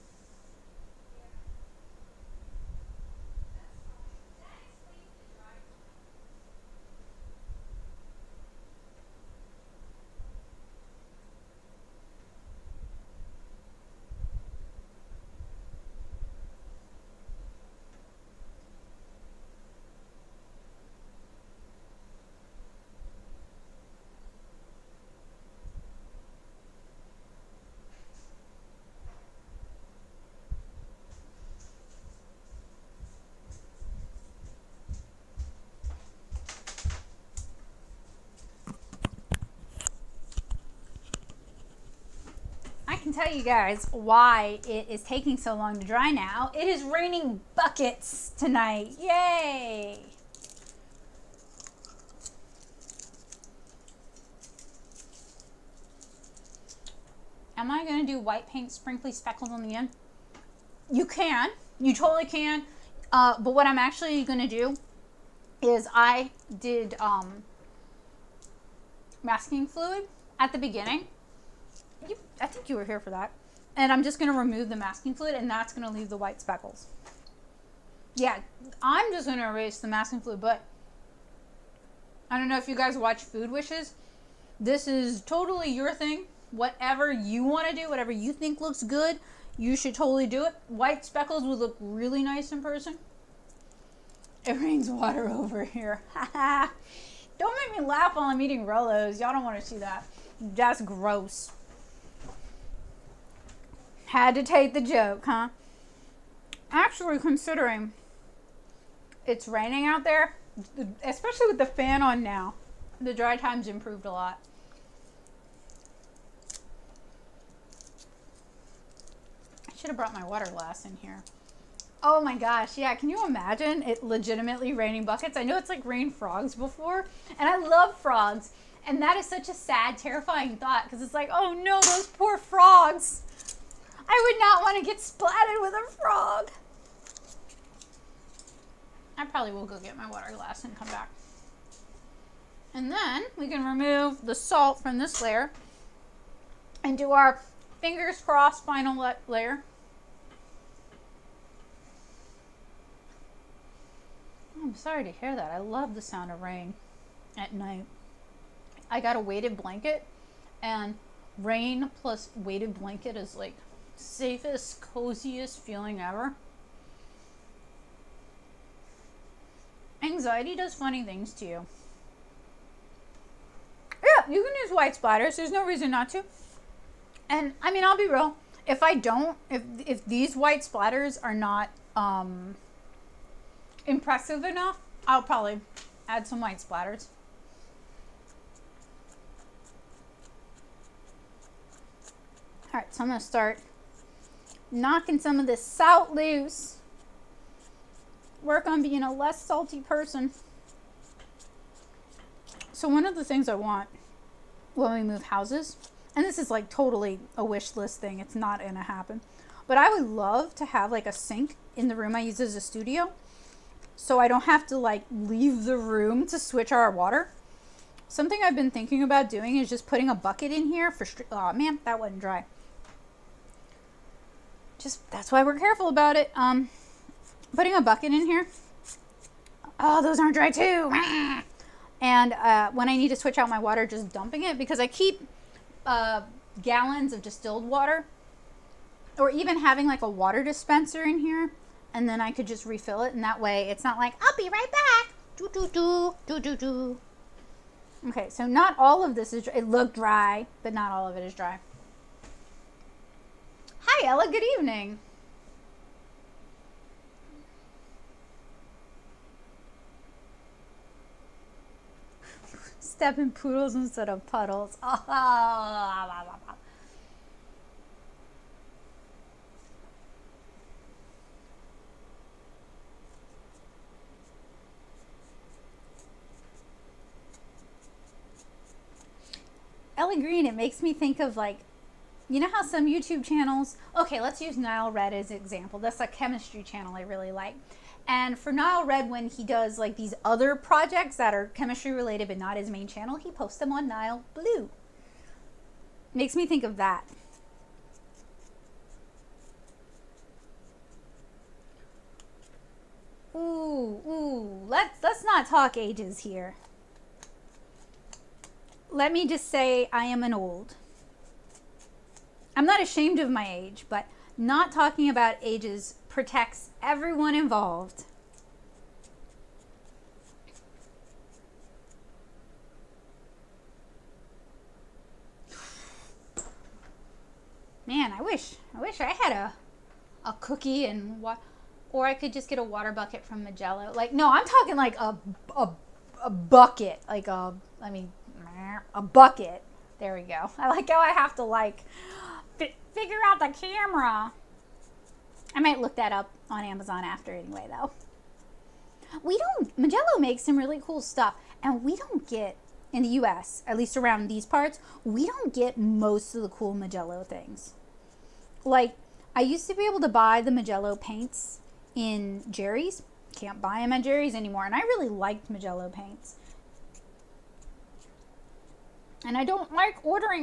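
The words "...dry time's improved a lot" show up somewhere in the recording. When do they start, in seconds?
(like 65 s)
113 s.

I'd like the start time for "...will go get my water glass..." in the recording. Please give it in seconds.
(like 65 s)
139 s.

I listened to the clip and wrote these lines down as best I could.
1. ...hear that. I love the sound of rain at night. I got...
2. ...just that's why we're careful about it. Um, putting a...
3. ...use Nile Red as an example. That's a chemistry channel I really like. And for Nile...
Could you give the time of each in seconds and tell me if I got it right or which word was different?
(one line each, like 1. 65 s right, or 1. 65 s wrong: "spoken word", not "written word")
1. 155 s right
2. 224 s right
3. 284 s right.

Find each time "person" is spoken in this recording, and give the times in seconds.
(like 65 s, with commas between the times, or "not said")
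92 s, 199 s.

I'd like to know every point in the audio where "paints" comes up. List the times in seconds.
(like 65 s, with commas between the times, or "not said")
58 s, 360 s, 365 s.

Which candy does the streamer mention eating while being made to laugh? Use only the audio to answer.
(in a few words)
Rolos.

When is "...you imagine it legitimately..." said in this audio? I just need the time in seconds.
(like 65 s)
123 s.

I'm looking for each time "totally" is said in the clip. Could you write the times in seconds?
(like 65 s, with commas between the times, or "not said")
61 s, 85 s, 89 s, 206 s.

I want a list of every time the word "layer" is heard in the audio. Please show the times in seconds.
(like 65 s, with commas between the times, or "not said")
145 s, 149 s.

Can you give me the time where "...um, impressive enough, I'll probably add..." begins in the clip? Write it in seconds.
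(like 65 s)
181 s.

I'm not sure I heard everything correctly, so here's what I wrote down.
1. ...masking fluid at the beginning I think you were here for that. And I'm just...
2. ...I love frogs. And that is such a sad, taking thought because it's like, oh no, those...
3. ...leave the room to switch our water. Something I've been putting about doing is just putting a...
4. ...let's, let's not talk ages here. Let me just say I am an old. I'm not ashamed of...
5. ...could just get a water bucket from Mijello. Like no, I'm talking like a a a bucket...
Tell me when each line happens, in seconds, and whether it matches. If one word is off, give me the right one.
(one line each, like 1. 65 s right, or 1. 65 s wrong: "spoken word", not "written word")
1. 69 s right
2. 127 s wrong: "terrifying", not "taking"
3. 215 s wrong: "thinking", not "putting"
4. 304 s right
5. 332 s right.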